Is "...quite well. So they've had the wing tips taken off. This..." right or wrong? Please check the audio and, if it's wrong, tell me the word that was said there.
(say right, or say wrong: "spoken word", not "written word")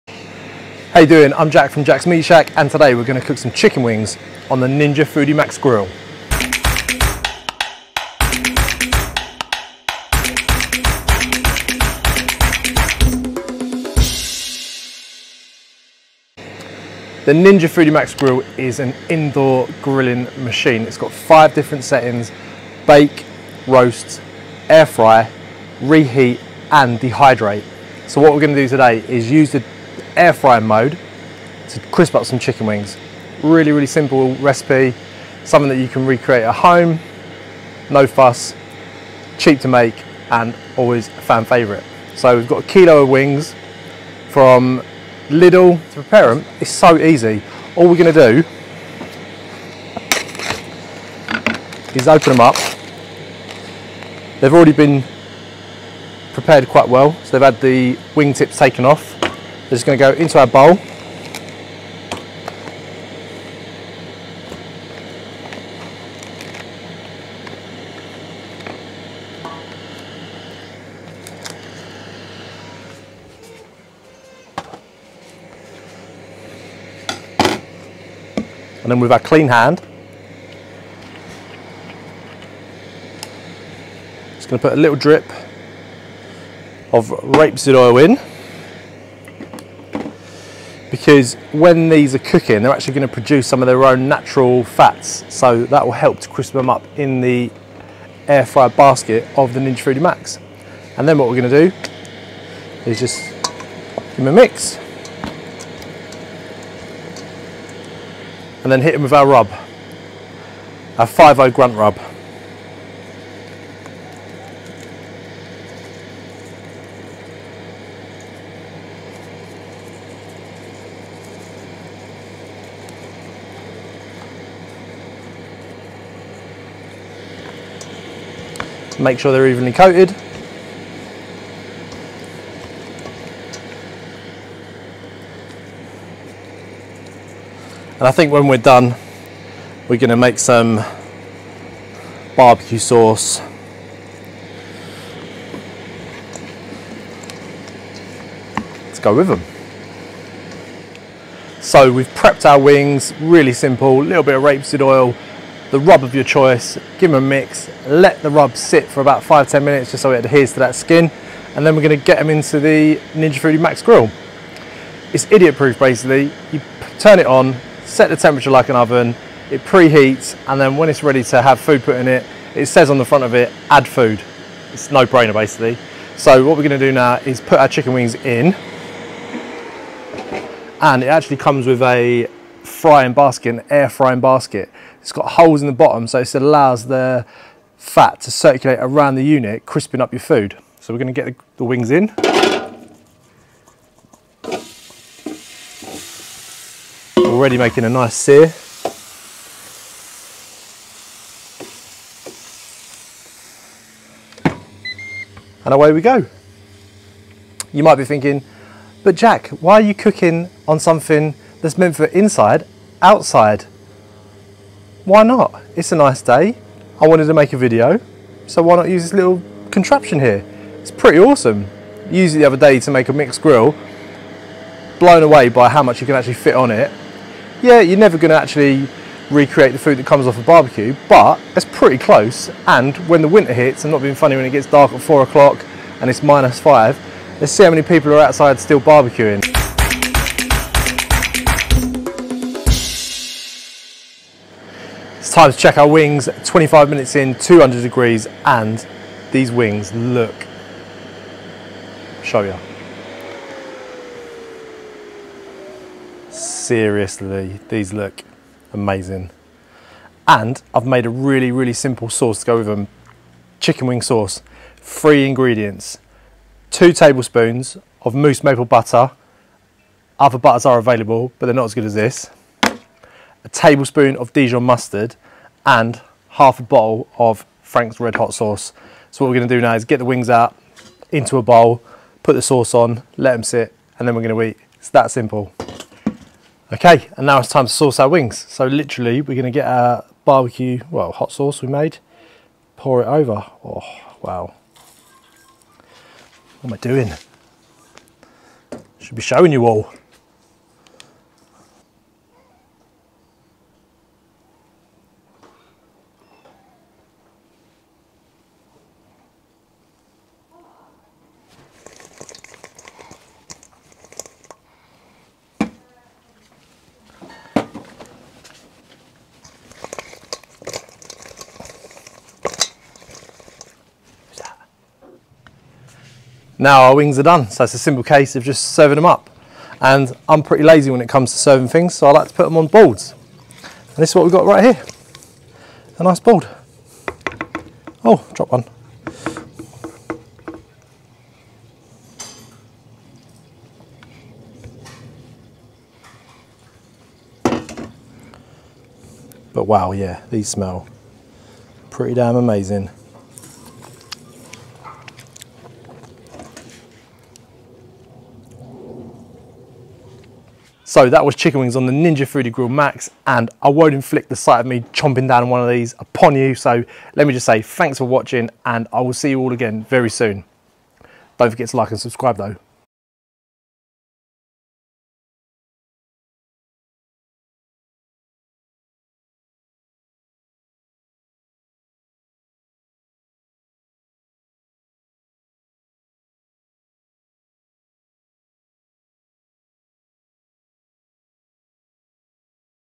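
right.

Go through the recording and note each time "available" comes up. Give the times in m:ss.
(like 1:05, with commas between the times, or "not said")
4:30.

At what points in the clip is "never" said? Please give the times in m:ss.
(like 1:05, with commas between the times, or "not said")
3:47.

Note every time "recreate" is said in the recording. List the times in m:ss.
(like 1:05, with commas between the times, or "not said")
0:36, 3:49.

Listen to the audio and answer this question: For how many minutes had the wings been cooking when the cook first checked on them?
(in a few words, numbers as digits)
25.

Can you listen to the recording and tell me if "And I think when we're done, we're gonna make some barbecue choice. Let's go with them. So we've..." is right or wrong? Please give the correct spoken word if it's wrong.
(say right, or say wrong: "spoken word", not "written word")
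wrong: "sauce", not "choice".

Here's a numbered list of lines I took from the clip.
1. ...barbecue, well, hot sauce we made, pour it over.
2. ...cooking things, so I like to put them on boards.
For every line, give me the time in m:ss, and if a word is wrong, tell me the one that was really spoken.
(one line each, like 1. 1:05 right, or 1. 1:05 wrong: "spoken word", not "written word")
1. 4:50 right
2. 5:31 wrong: "serving", not "cooking".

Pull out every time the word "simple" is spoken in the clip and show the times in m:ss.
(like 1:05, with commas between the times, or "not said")
0:33, 2:33, 4:21, 4:45, 5:27.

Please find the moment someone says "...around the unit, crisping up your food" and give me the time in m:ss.
3:08.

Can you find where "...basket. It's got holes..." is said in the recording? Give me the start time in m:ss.
3:04.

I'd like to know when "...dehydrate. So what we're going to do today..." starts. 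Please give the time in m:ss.
0:26.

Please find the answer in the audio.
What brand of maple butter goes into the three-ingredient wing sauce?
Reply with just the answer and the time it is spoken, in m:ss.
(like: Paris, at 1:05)
Moose, at 4:28.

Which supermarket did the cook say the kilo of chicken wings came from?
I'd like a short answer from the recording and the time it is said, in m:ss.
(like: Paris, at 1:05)
Lidl, at 0:45.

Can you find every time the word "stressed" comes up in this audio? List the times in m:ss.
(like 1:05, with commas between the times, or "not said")
not said.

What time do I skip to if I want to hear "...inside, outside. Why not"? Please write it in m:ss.
3:32.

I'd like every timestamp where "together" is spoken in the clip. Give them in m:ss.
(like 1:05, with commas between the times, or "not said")
not said.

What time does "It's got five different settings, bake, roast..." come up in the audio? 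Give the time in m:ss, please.
0:20.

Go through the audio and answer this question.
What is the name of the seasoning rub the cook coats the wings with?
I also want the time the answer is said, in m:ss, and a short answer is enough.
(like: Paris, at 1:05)
5 grunt rub, at 1:51.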